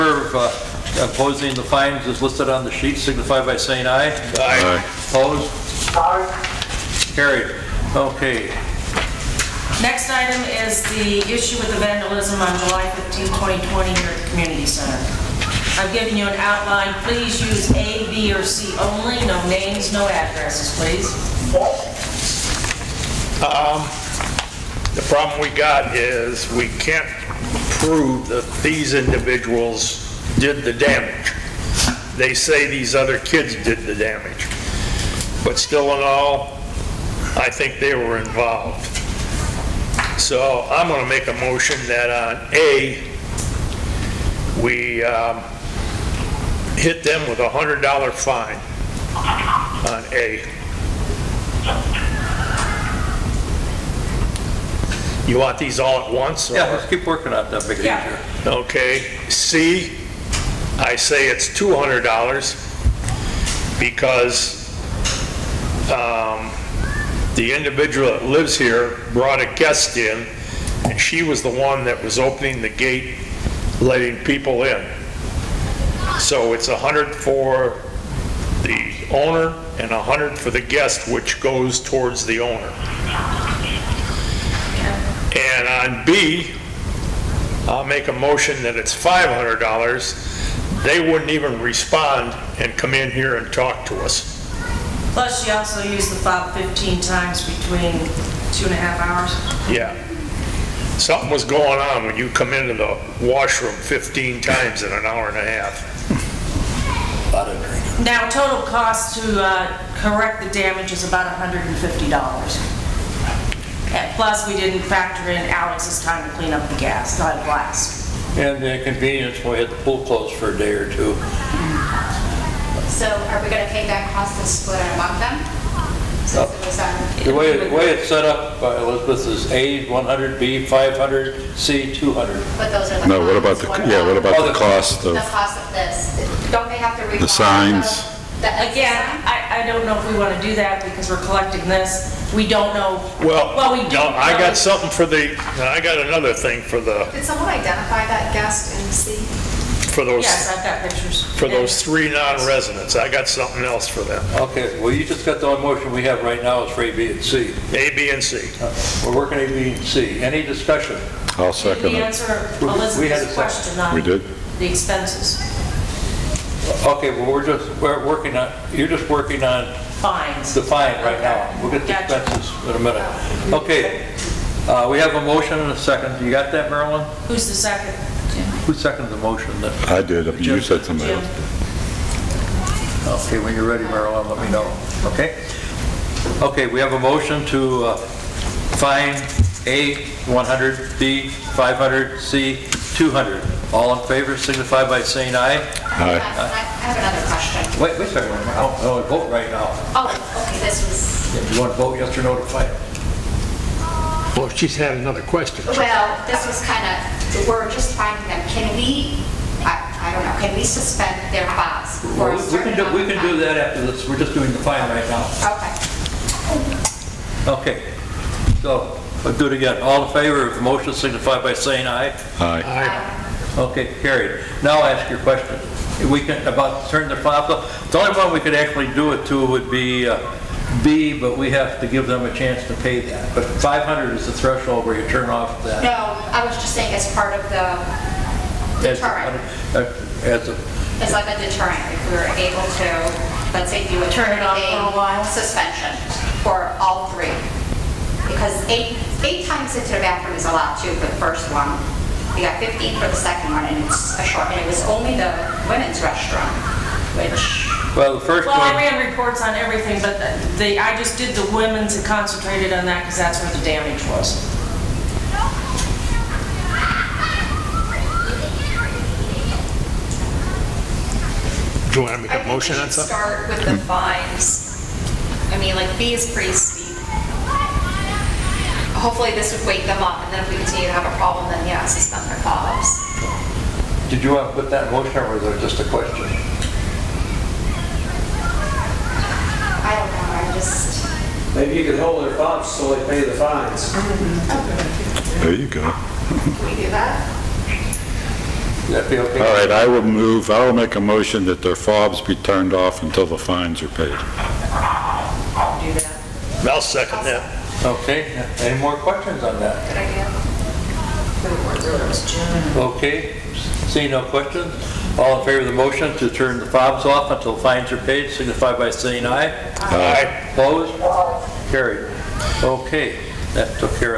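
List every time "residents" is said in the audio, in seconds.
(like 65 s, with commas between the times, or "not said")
152 s.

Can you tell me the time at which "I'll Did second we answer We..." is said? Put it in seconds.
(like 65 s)
161 s.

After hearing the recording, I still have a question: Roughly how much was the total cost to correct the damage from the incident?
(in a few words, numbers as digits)
$150.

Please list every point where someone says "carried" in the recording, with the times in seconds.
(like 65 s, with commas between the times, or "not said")
7 s, 224 s, 321 s.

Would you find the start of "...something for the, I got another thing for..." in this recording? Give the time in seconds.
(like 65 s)
144 s.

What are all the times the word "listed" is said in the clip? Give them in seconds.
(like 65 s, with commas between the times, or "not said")
2 s.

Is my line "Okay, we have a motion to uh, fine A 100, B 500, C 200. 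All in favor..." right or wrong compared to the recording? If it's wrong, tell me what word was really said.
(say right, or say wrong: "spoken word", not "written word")
right.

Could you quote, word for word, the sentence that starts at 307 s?
Okay, any more questions on that?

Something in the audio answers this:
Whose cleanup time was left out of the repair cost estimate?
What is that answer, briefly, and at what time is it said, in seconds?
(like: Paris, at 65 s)
Alex, at 115 s.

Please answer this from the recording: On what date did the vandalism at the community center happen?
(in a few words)
July 15, 2020.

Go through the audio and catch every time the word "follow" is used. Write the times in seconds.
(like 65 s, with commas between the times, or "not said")
282 s.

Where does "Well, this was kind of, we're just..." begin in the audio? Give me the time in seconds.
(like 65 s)
205 s.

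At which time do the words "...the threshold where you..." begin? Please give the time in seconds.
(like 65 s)
234 s.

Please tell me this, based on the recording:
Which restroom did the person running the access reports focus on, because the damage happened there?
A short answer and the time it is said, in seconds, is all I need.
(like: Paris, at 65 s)
The women's restroom, at 255 s.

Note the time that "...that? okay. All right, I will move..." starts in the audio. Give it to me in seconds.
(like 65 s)
296 s.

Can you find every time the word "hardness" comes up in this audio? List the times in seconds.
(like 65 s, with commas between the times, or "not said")
not said.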